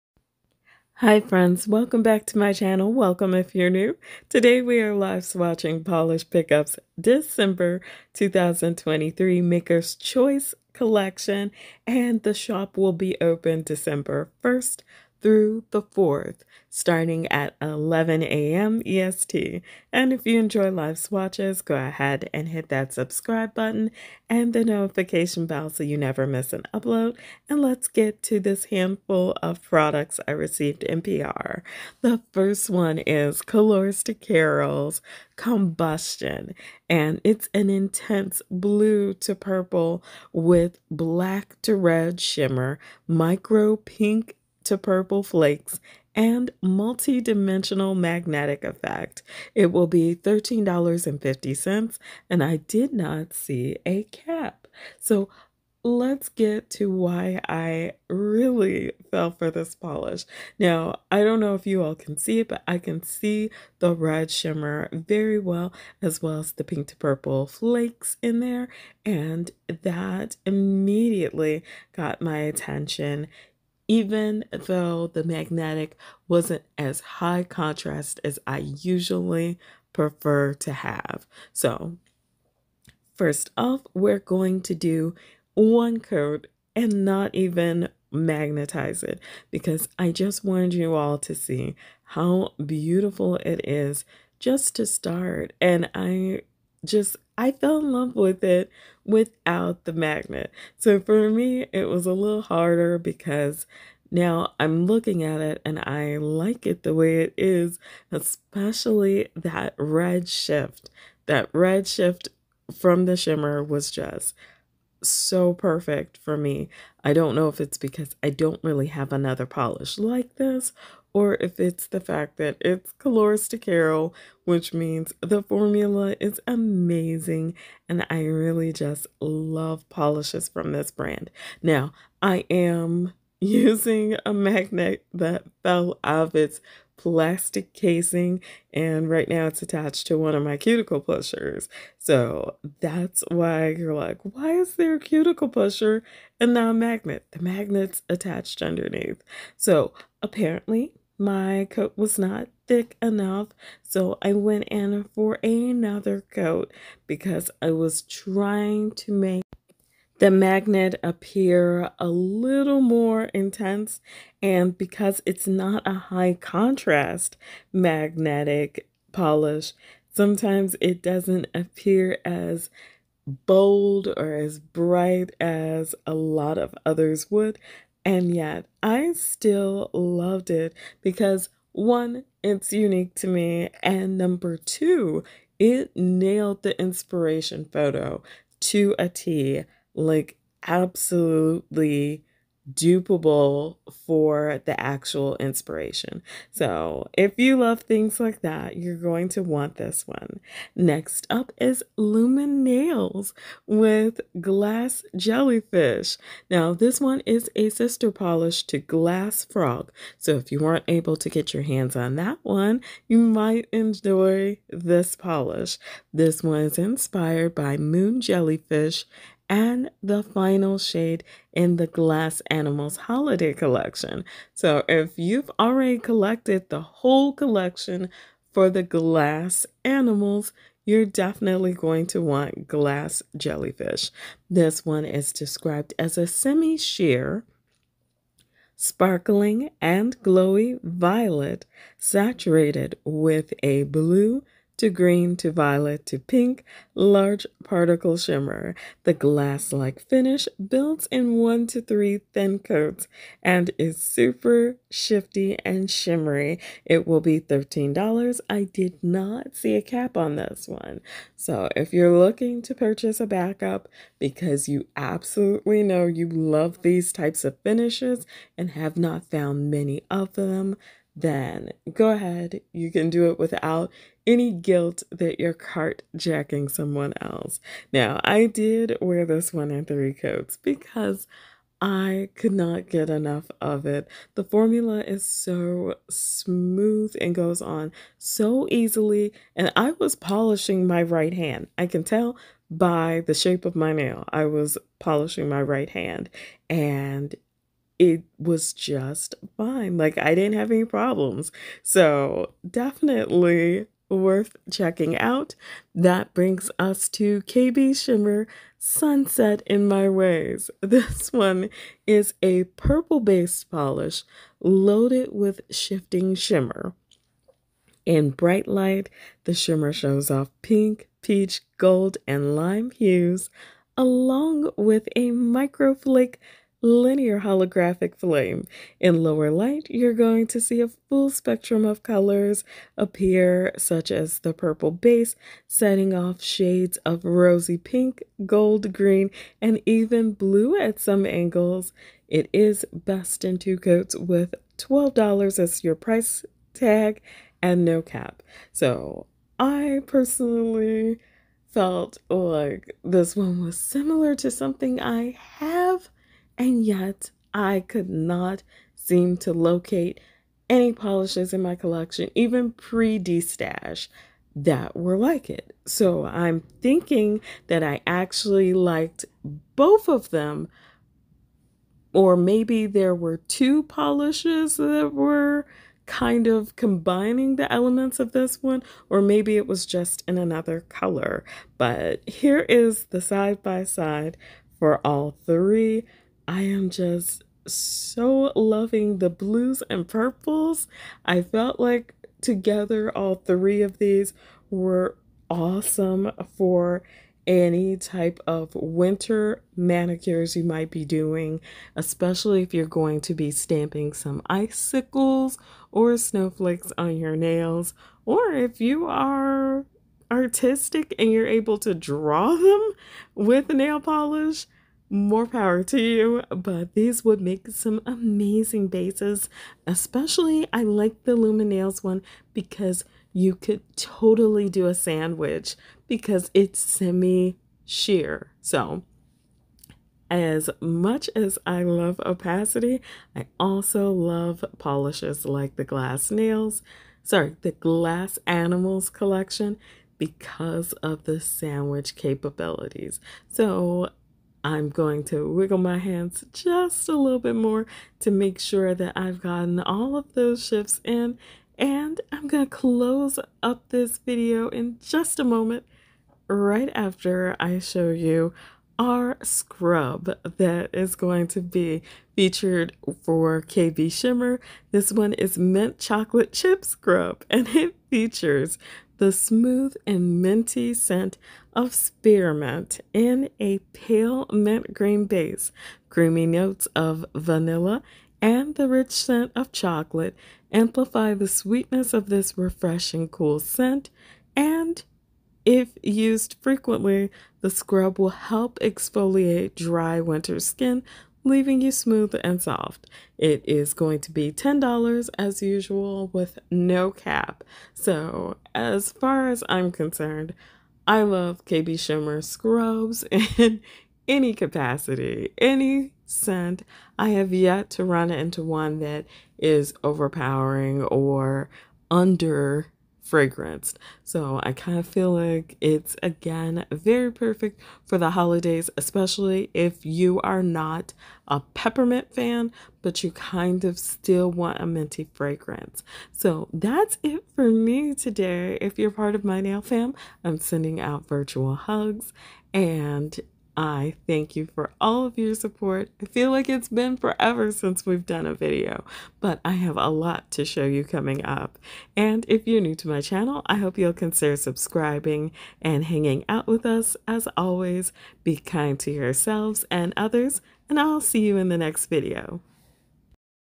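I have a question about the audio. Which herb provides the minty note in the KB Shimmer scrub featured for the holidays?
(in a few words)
spearmint.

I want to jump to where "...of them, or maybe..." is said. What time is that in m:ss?
6:10.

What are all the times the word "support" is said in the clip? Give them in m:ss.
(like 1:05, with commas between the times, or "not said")
8:55.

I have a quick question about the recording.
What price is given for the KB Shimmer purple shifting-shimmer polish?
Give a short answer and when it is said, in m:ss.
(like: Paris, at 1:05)
$12, at 5:44.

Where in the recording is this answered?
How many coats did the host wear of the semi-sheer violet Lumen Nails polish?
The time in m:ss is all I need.
4:39.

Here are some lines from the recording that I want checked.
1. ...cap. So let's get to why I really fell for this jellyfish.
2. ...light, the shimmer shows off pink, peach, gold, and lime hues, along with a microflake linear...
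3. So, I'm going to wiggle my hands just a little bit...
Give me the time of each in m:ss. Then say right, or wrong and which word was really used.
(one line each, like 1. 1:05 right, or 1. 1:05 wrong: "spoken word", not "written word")
1. 0:54 wrong: "polish", not "jellyfish"
2. 5:18 right
3. 7:23 right.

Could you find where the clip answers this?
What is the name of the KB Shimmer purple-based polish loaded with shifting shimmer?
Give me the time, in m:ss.
5:08.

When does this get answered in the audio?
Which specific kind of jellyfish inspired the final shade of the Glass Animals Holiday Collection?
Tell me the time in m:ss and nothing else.
3:37.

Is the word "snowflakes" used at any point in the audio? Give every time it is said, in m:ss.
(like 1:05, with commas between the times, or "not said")
6:46.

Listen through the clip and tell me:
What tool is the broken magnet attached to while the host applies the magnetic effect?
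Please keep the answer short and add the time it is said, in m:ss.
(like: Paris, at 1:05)
cuticle pusher, at 2:20.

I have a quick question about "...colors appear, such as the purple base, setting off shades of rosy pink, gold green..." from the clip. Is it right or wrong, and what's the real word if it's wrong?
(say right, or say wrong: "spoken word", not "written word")
right.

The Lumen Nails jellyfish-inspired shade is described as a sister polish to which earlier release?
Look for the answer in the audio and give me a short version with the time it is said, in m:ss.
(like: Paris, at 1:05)
Glass Frog, at 3:28.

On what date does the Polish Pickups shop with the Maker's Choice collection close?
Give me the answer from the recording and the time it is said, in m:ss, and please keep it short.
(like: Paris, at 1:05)
December 4th, at 0:15.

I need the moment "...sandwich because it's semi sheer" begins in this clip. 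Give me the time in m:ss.
7:04.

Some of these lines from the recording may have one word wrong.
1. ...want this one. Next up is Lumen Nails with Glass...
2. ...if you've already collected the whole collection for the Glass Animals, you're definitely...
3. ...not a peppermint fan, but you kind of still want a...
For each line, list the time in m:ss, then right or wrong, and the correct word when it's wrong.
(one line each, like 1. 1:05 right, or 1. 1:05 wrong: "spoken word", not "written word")
1. 3:19 right
2. 3:44 right
3. 8:40 right.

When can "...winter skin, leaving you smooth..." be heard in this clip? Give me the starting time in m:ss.
8:10.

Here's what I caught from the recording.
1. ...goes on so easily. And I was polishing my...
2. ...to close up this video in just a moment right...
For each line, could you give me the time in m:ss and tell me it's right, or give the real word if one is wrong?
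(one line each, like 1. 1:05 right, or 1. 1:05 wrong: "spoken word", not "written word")
1. 4:47 right
2. 7:32 right.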